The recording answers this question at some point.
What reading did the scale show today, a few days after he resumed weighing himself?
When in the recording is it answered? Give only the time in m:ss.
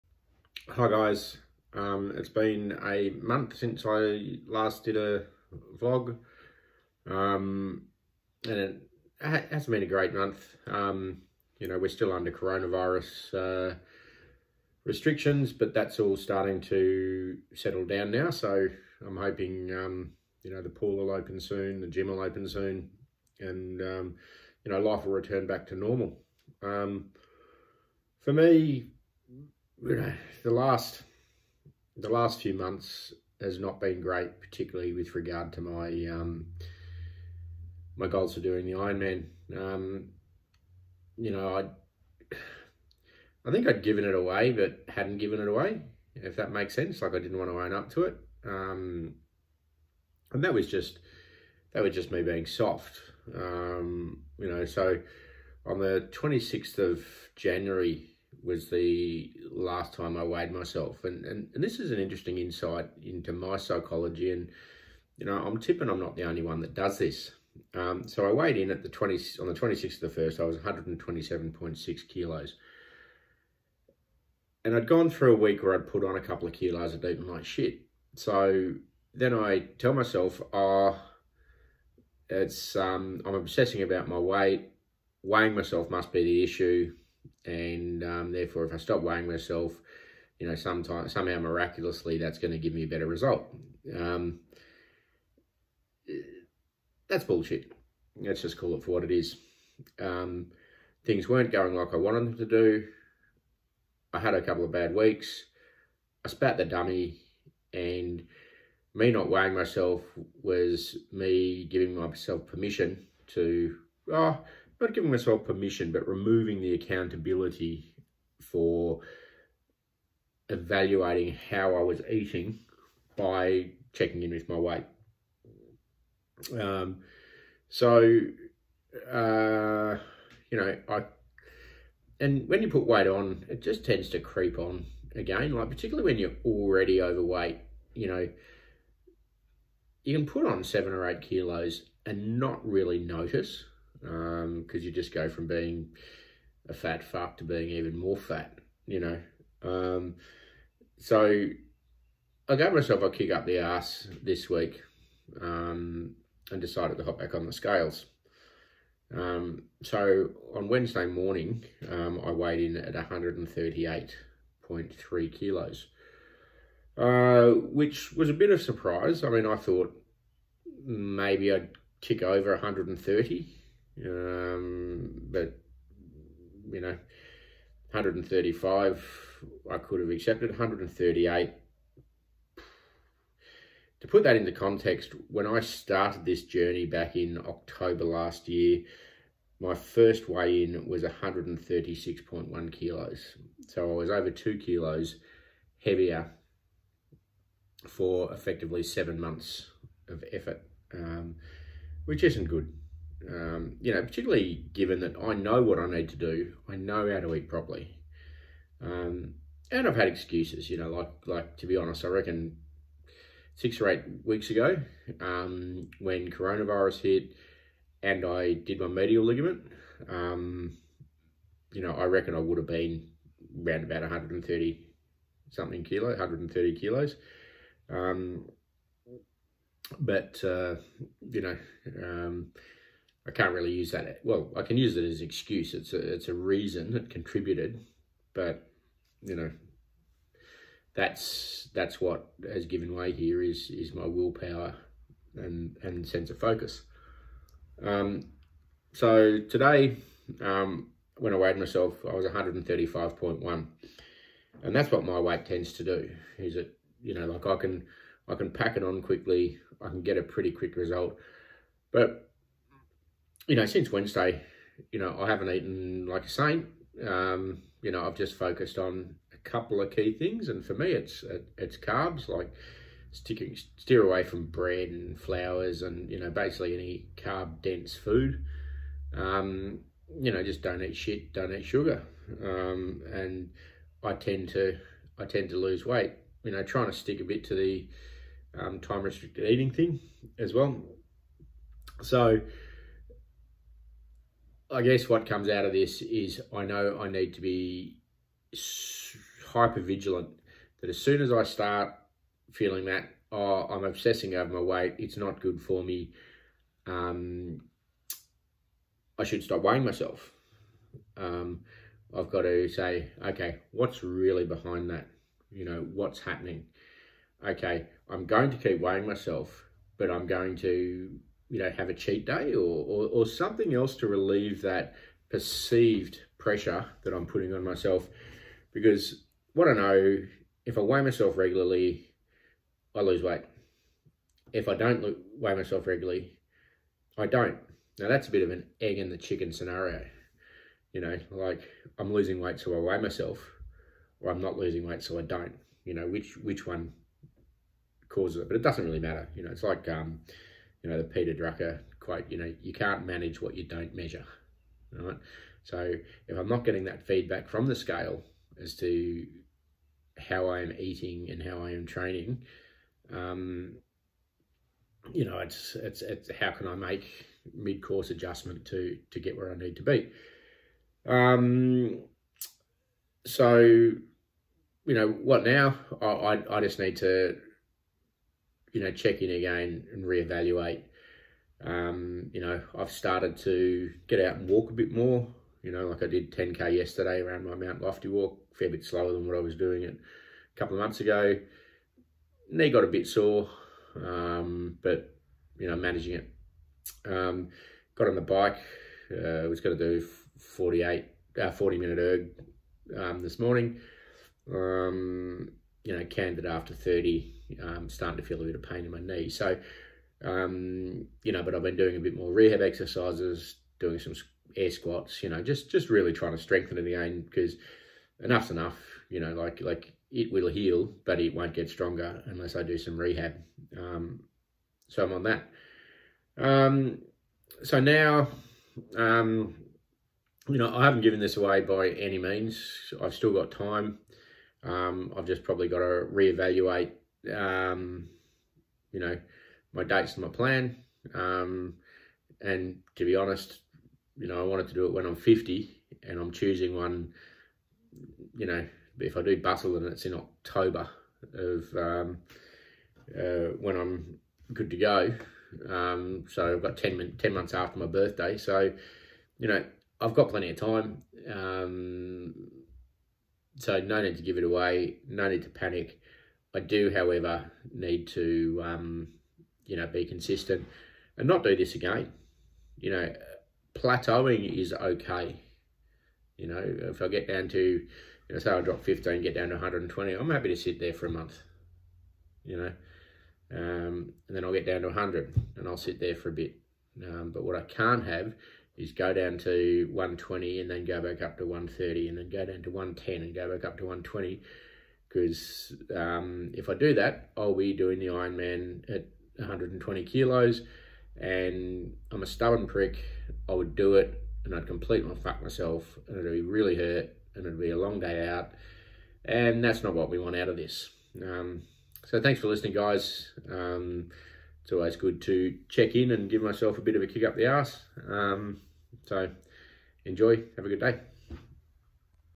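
4:12.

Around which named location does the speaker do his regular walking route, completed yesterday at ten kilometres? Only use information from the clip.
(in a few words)
Mount Lofty.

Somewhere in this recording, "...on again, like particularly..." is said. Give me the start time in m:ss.
2:14.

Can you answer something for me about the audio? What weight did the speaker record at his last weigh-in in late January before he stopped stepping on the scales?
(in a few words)
127.6 kilos.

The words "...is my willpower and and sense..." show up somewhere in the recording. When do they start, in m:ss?
4:03.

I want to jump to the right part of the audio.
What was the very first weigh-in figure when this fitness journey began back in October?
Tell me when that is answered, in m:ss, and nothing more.
3:11.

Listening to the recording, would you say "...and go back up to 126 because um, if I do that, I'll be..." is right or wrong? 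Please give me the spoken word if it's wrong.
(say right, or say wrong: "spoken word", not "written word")
wrong: "120", not "126".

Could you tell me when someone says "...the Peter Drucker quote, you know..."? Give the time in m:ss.
5:50.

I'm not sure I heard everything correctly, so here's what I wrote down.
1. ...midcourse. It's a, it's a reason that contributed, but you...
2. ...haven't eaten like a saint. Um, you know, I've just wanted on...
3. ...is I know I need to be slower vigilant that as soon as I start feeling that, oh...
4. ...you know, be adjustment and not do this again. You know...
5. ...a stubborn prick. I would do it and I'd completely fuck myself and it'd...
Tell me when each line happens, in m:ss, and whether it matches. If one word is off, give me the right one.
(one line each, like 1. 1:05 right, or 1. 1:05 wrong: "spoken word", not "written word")
1. 3:55 wrong: "excuse", not "midcourse"
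2. 4:25 wrong: "focused", not "wanted"
3. 4:56 wrong: "hyper", not "slower"
4. 7:49 wrong: "consistent", not "adjustment"
5. 8:22 right.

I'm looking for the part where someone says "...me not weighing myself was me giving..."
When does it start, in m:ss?
1:48.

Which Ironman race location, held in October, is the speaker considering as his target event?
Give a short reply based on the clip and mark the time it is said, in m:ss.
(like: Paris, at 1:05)
Busselton, at 7:29.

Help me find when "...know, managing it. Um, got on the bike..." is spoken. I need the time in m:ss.
6:35.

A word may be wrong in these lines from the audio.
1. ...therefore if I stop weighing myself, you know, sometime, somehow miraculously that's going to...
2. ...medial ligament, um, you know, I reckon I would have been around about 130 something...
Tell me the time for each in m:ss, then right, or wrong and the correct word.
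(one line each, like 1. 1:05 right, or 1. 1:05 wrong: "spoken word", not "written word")
1. 1:28 right
2. 3:38 right.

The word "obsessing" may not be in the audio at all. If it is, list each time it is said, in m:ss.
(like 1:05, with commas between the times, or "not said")
1:23, 5:03.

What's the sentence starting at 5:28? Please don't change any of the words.
Because what I know, if I weigh myself regularly, I lose weight.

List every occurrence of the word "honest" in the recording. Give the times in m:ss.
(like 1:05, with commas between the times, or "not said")
3:31, 7:23.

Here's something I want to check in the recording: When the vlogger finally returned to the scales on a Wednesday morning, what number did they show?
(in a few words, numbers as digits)
138.3 kilos.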